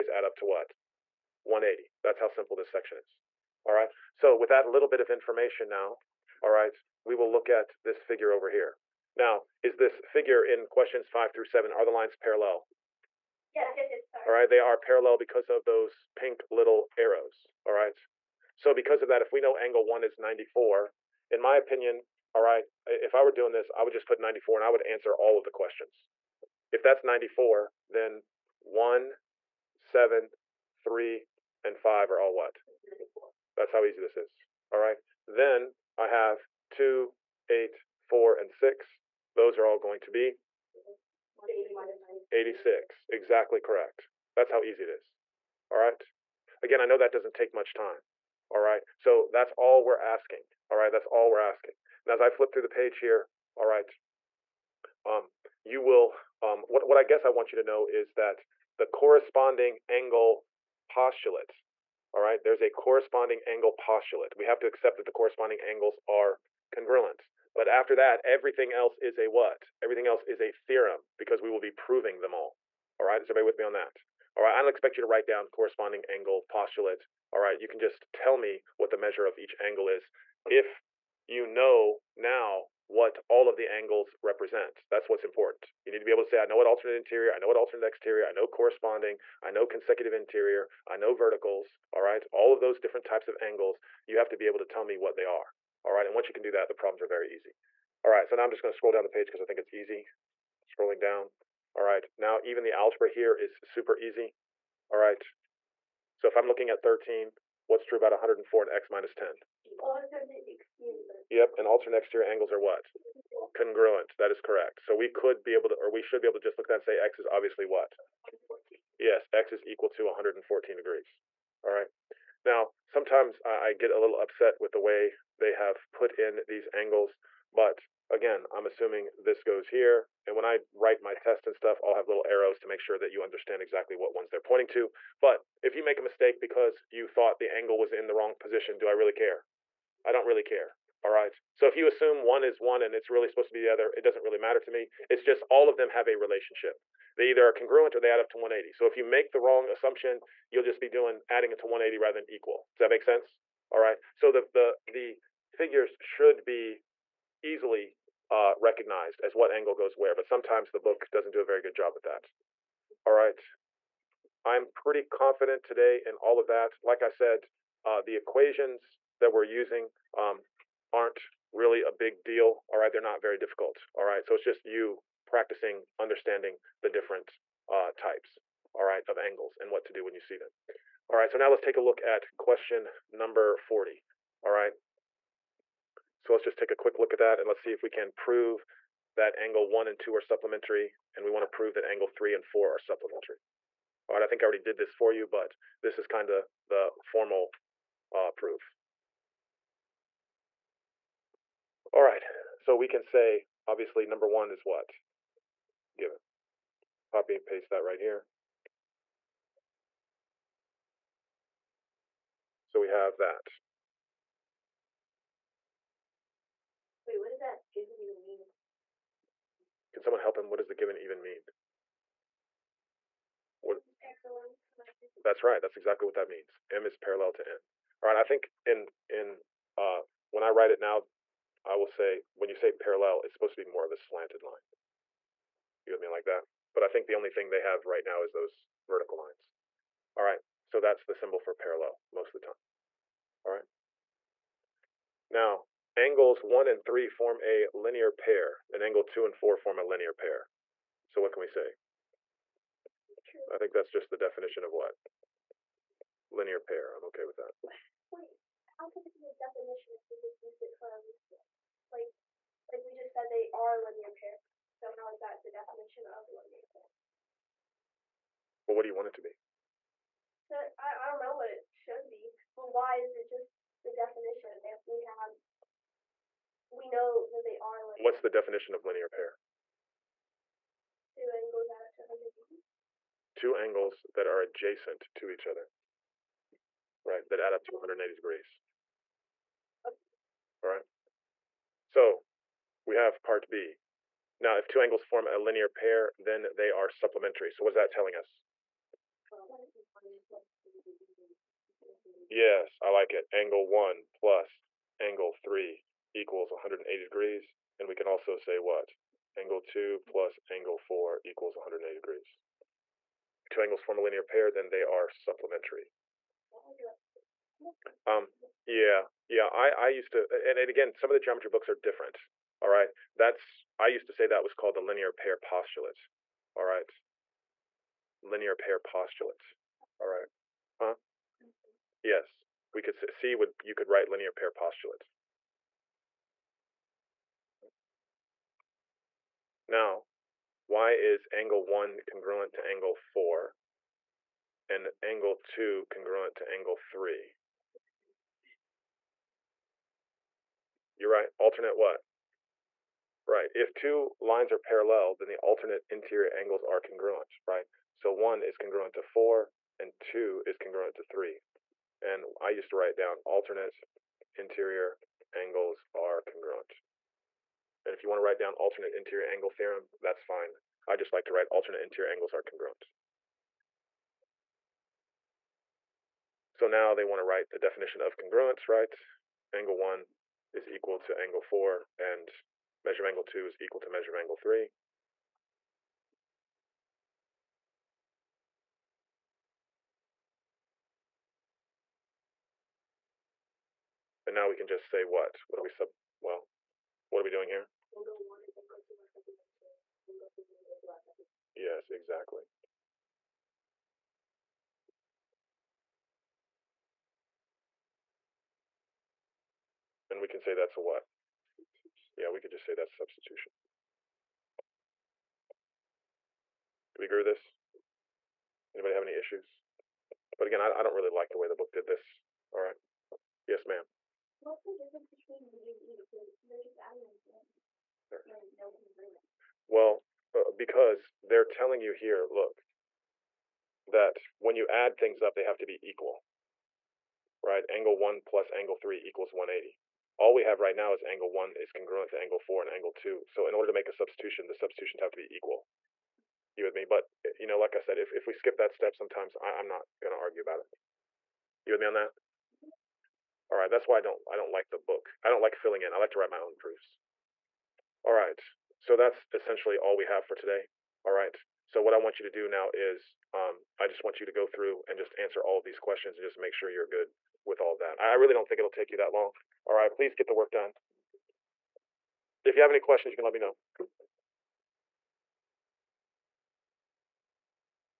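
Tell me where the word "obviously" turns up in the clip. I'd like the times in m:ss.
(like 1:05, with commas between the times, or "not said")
1:57, 3:23.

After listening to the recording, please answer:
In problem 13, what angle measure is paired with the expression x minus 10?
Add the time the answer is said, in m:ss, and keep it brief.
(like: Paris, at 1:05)
104, at 1:48.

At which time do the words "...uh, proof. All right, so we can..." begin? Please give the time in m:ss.
3:18.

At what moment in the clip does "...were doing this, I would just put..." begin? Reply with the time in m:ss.
0:23.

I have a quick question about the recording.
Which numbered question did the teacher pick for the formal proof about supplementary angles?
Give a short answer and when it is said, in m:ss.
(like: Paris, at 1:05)
40, at 3:03.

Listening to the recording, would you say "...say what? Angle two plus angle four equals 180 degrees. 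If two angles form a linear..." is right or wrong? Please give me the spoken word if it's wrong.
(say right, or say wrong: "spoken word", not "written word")
right.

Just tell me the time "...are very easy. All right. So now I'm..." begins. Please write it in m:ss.
1:37.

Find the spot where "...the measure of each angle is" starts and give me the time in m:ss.
1:18.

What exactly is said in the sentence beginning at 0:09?
Now, is this figure in questions five through seven, are the lines parallel?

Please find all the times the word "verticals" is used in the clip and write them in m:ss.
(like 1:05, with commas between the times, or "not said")
1:31, 3:58.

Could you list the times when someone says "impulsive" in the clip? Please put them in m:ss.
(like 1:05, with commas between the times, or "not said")
not said.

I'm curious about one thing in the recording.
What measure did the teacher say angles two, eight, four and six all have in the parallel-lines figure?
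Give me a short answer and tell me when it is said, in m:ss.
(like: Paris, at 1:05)
86, at 0:42.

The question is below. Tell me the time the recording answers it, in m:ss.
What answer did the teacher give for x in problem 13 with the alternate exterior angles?
2:00.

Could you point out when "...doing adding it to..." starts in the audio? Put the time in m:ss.
2:30.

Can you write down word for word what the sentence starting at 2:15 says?
But if you make a mistake because you thought the angle was in the wrong position, do I really care?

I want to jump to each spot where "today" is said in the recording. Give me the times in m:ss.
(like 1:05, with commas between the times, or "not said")
2:45, 7:40.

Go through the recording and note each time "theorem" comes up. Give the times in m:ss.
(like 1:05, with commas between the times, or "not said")
1:10, 6:09.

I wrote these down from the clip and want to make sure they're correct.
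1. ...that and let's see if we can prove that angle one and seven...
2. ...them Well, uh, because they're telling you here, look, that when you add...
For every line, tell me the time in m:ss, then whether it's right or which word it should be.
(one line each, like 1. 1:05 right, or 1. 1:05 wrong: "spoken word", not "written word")
1. 3:07 wrong: "two", not "seven"
2. 7:08 right.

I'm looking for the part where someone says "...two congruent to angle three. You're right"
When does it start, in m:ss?
5:45.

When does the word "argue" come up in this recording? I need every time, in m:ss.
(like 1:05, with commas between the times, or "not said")
7:30.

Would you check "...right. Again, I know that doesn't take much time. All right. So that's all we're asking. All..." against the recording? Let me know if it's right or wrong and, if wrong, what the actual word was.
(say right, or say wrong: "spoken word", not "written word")
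right.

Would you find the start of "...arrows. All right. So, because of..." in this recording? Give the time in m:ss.
0:16.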